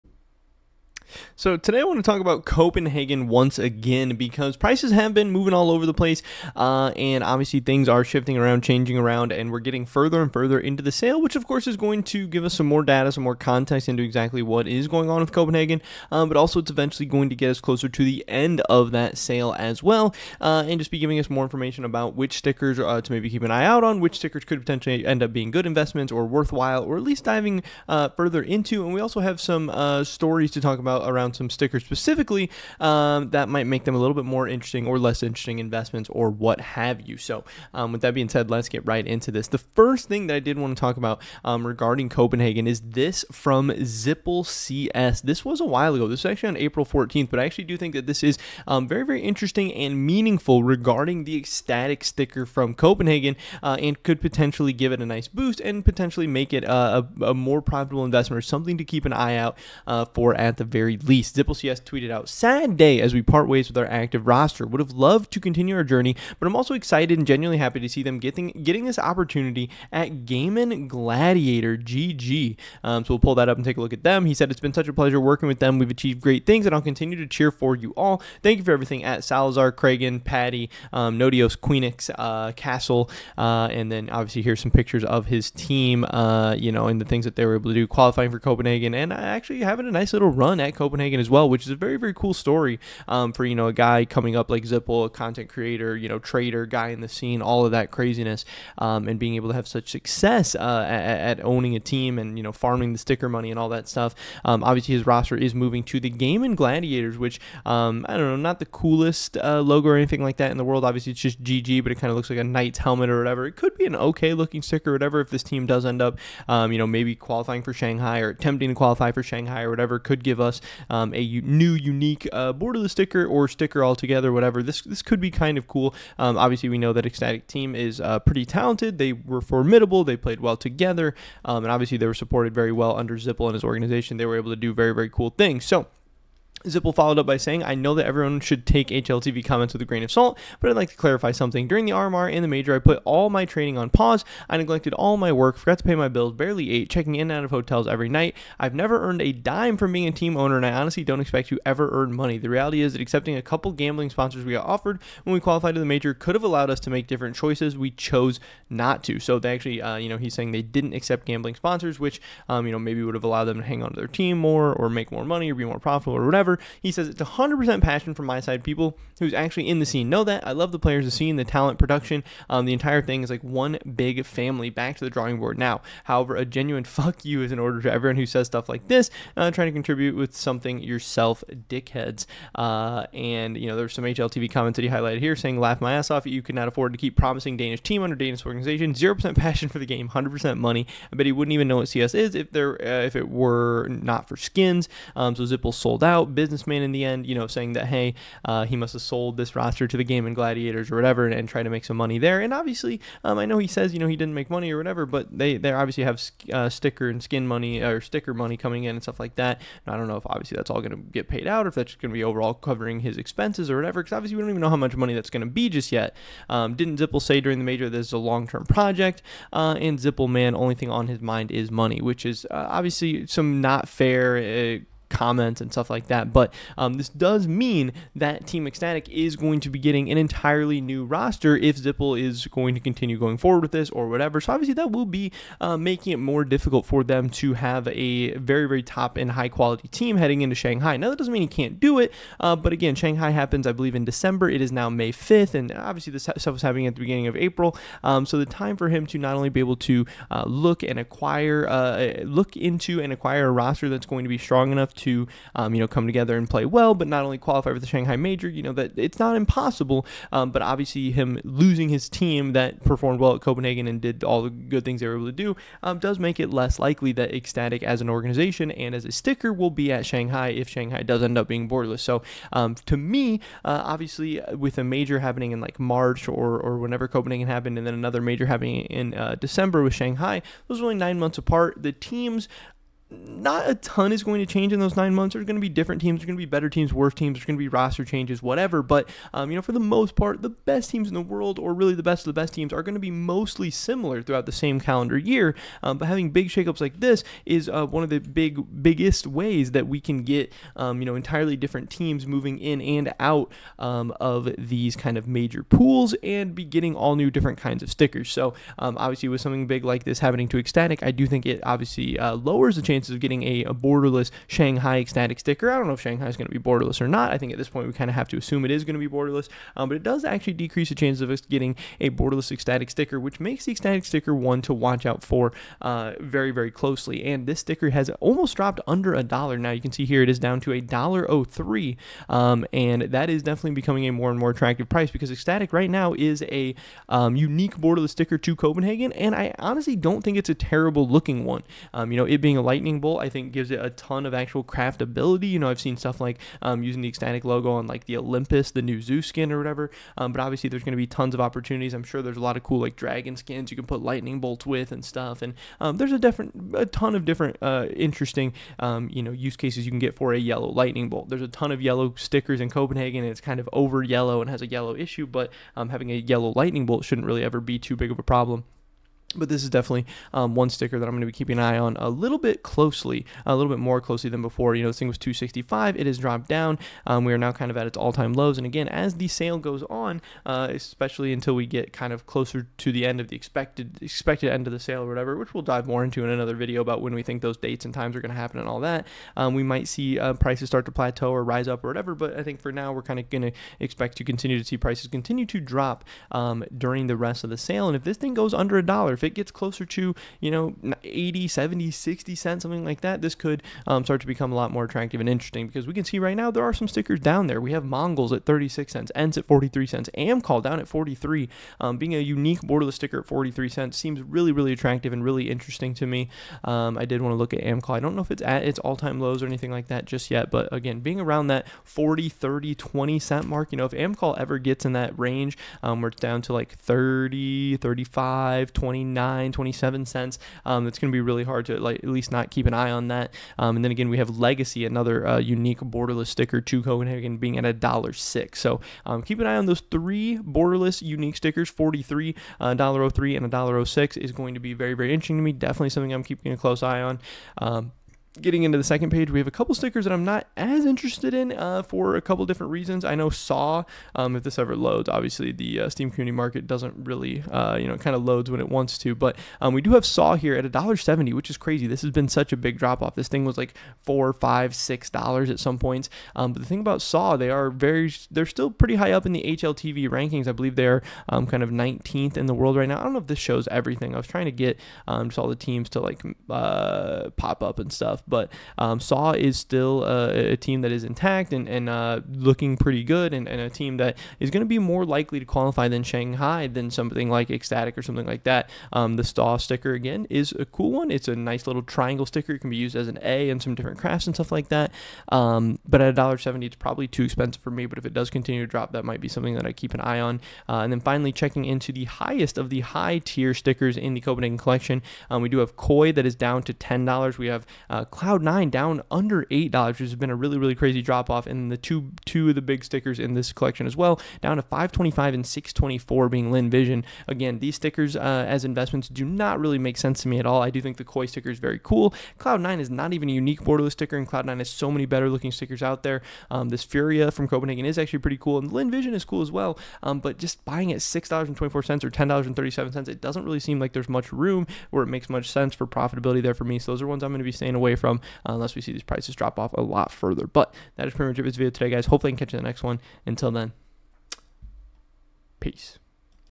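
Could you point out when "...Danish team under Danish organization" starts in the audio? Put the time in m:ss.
3:07.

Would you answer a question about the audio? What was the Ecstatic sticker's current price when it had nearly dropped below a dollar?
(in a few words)
$1.03.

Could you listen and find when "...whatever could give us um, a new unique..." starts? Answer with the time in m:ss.
1:59.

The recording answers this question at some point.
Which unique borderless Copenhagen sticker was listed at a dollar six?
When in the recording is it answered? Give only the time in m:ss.
7:14.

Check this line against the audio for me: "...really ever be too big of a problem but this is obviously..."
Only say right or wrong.
wrong.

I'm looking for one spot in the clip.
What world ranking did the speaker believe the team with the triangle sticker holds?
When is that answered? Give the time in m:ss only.
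7:51.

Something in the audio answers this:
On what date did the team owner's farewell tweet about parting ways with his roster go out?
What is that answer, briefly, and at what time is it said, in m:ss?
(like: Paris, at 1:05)
April 14th, at 0:46.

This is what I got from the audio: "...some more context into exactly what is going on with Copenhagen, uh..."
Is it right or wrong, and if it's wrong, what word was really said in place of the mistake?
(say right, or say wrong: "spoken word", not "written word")
right.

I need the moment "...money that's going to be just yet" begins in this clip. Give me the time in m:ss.
3:34.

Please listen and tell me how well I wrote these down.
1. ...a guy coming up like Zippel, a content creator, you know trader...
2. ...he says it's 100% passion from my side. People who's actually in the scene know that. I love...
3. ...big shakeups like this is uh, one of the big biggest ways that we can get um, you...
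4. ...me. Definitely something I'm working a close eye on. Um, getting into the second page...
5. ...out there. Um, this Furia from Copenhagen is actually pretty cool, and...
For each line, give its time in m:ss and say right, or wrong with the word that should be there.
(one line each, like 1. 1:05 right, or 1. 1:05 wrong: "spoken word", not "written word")
1. 1:33 right
2. 2:46 right
3. 4:56 right
4. 7:25 wrong: "keeping", not "working"
5. 8:45 right.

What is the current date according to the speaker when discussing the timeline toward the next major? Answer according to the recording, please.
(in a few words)
May 5th.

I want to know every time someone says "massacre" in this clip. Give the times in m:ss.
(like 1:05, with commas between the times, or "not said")
not said.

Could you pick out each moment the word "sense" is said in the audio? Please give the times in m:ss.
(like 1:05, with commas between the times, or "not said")
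8:39, 8:55.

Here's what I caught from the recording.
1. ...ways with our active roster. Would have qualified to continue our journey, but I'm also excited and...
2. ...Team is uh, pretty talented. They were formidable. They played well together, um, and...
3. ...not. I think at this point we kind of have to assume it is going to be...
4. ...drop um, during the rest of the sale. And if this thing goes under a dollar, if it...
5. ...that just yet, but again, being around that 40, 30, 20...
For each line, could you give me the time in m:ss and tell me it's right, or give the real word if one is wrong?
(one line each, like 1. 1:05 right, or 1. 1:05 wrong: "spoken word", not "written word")
1. 1:03 wrong: "loved", not "qualified"
2. 2:07 right
3. 5:17 right
4. 6:35 right
5. 6:59 right.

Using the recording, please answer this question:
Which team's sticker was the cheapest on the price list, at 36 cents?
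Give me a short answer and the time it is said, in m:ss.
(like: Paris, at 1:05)
MongolZ, at 6:47.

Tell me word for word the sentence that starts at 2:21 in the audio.
During the RMR and the major, I put all my training on pause.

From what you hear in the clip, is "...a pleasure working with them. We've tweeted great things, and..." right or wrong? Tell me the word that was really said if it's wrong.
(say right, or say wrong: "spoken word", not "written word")
wrong: "achieved", not "tweeted".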